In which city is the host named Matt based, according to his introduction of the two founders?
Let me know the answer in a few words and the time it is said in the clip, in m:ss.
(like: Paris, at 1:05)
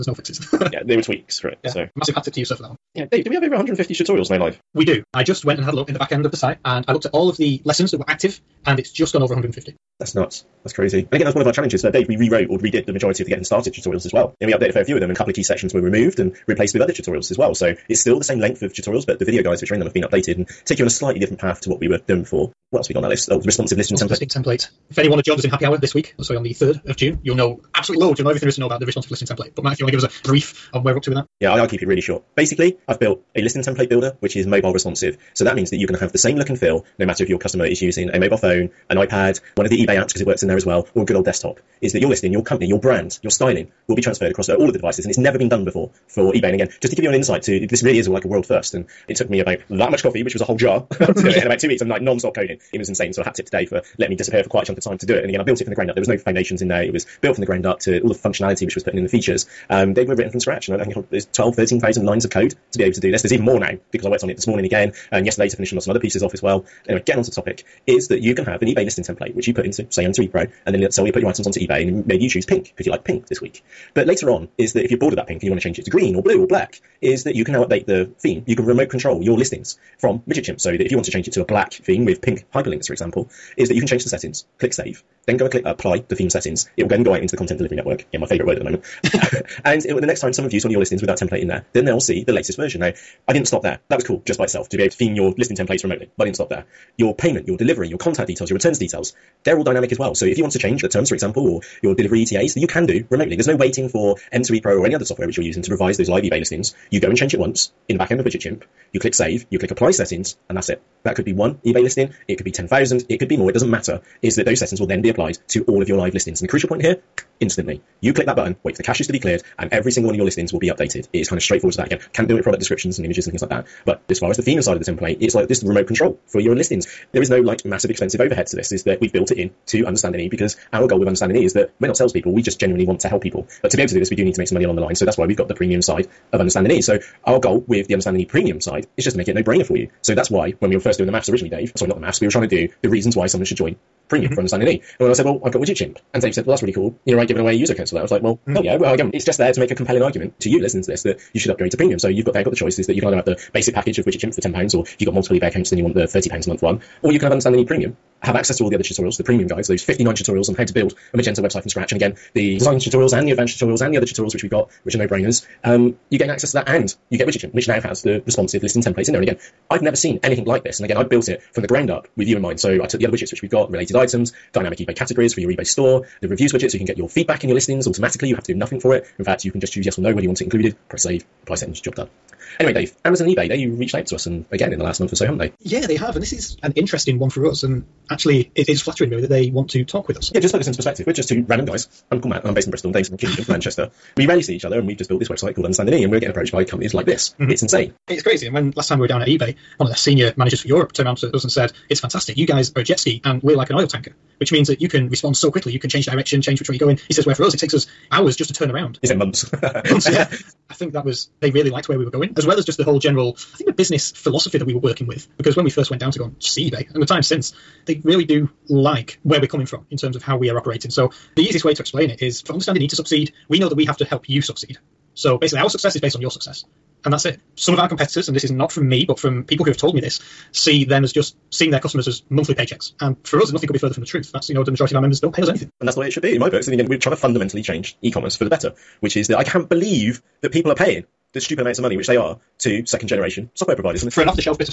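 Bristol, at 3:12.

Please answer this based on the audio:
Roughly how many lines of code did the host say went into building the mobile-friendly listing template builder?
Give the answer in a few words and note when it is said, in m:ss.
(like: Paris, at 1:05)
12,000-13,000, at 1:01.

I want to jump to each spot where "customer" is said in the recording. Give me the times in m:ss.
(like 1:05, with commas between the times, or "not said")
0:37, 3:51.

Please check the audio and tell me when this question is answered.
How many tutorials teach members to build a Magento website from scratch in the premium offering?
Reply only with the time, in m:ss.
2:39.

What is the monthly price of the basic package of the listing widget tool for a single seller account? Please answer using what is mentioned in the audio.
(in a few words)
£10.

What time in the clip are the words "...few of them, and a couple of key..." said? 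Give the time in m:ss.
0:14.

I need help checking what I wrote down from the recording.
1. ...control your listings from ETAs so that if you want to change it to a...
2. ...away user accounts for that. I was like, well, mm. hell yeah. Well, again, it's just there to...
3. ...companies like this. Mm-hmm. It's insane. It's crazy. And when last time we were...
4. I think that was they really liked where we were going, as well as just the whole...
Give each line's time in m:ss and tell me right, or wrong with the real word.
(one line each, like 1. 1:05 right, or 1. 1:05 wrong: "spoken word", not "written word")
1. 1:18 wrong: "WidgetChimp", not "ETAs"
2. 2:27 right
3. 3:16 right
4. 3:30 right.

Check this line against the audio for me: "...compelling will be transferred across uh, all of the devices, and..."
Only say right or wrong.
wrong.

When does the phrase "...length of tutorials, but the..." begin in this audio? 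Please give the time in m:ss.
0:18.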